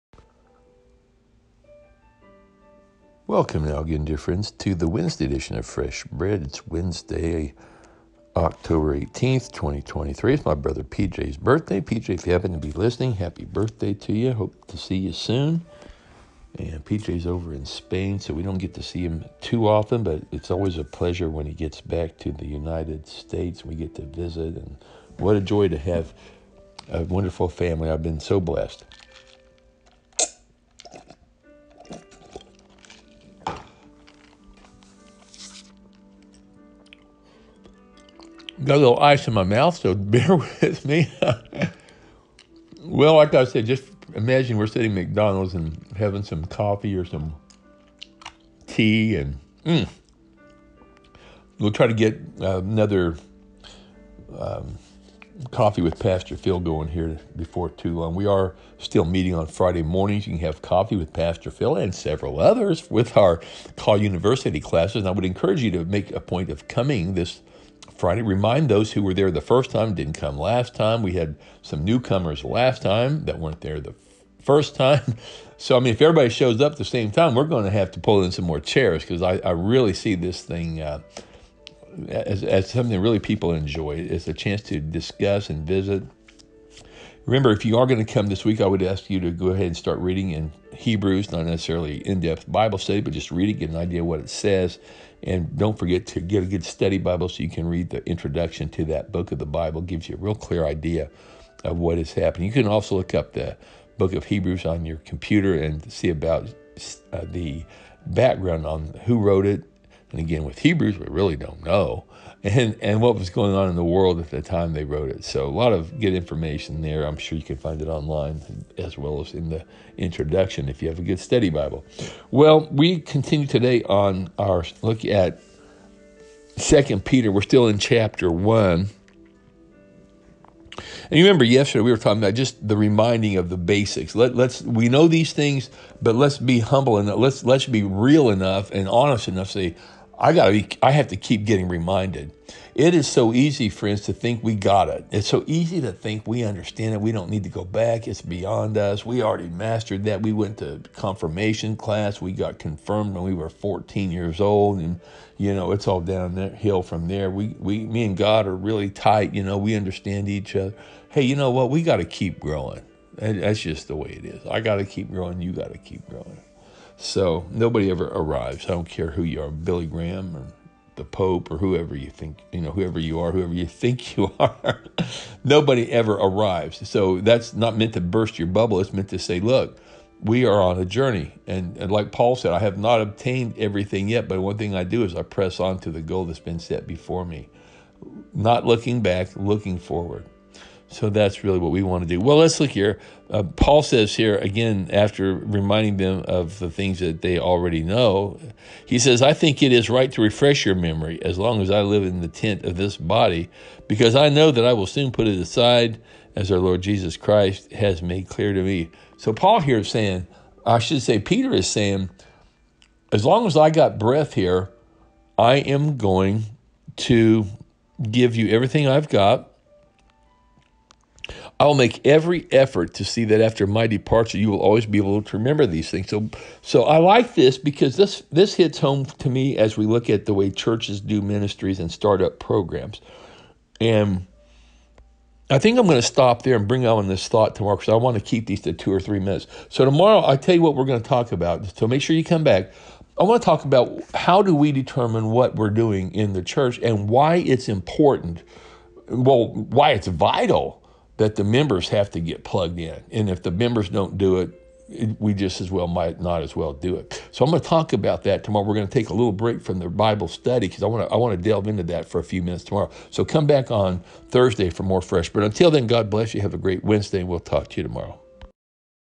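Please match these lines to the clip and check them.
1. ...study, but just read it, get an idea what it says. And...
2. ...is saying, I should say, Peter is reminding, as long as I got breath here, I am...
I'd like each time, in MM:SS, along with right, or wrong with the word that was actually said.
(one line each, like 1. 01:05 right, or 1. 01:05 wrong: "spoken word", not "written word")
1. 01:32 right
2. 03:29 wrong: "saying", not "reminding".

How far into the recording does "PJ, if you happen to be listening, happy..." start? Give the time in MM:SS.
00:11.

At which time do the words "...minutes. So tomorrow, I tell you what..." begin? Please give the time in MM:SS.
03:59.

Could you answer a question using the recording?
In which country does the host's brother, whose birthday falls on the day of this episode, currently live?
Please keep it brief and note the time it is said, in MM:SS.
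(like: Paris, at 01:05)
Spain, at 00:17.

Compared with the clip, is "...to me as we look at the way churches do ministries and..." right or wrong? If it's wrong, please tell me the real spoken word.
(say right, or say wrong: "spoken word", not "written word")
right.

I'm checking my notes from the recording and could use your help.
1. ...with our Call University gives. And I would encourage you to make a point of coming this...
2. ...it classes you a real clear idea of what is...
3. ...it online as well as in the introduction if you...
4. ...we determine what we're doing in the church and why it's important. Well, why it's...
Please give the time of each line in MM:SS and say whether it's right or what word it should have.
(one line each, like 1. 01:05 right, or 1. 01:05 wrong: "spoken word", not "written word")
1. 01:02 wrong: "classes", not "gives"
2. 01:39 wrong: "gives", not "classes"
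3. 01:57 right
4. 04:04 right.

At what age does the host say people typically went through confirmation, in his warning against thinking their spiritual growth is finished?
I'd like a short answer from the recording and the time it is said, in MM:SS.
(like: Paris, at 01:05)
14, at 02:33.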